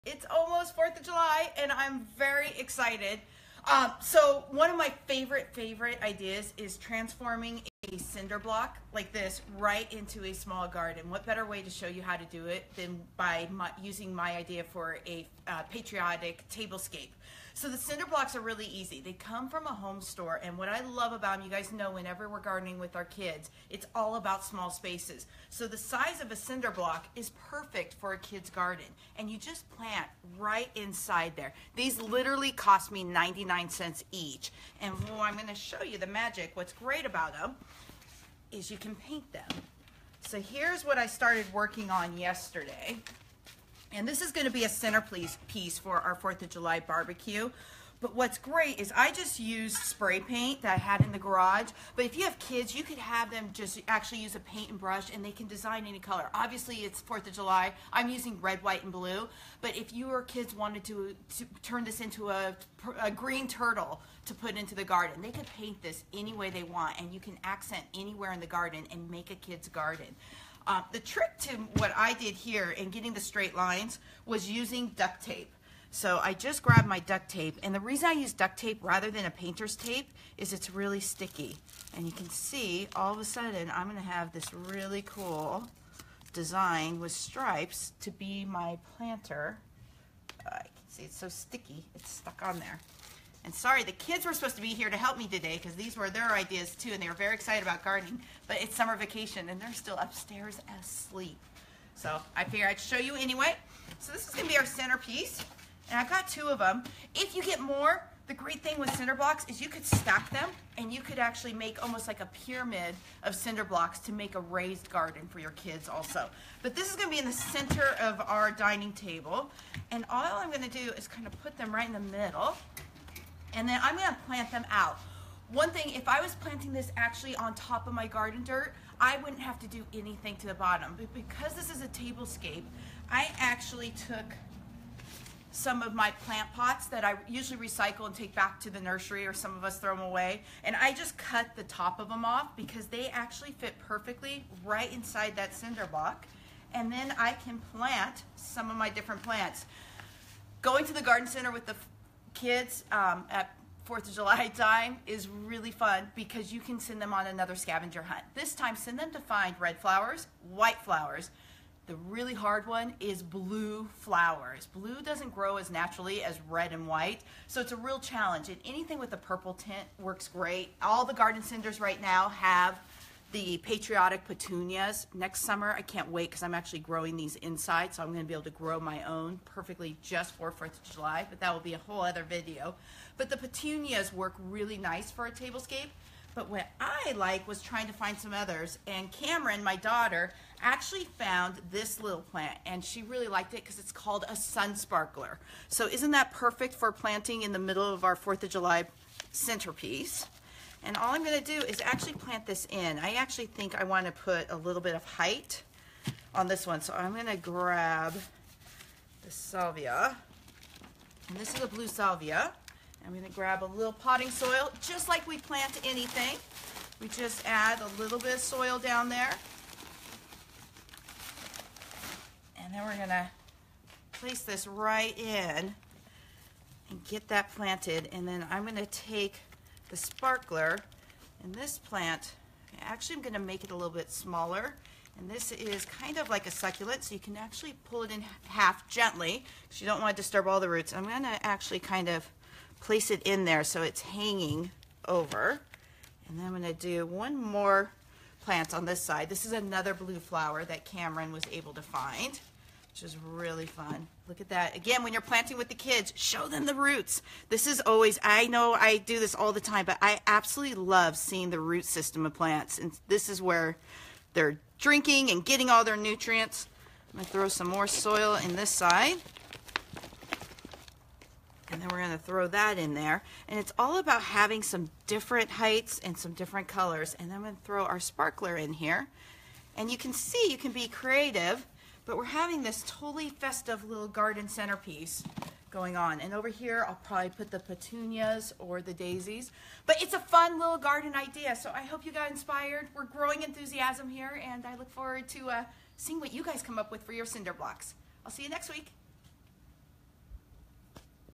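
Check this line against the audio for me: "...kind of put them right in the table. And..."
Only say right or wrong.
wrong.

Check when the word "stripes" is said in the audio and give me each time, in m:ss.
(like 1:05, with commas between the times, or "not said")
1:27.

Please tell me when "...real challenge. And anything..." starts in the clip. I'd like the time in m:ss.
2:47.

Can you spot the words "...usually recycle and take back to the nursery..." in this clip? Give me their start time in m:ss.
2:17.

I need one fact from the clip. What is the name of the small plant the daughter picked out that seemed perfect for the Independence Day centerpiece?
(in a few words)
sun sparkler.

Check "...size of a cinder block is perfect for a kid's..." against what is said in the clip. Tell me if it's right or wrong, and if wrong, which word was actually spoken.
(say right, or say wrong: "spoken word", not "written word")
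right.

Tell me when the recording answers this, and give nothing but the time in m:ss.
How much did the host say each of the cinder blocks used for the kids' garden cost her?
0:33.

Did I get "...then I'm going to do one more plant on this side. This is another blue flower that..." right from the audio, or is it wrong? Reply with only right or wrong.
right.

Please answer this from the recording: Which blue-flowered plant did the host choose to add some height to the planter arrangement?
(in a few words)
blue salvia.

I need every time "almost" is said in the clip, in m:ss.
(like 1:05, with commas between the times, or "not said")
0:00, 1:51.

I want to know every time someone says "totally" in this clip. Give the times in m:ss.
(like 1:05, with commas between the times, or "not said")
4:42.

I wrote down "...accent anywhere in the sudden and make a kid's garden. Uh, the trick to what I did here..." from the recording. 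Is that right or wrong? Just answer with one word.
wrong.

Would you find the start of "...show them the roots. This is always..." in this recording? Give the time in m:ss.
4:16.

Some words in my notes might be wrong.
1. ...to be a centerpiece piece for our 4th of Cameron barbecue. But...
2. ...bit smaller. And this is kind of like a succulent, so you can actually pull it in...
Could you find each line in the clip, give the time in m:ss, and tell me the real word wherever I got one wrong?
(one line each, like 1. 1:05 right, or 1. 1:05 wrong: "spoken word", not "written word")
1. 0:44 wrong: "July", not "Cameron"
2. 3:53 right.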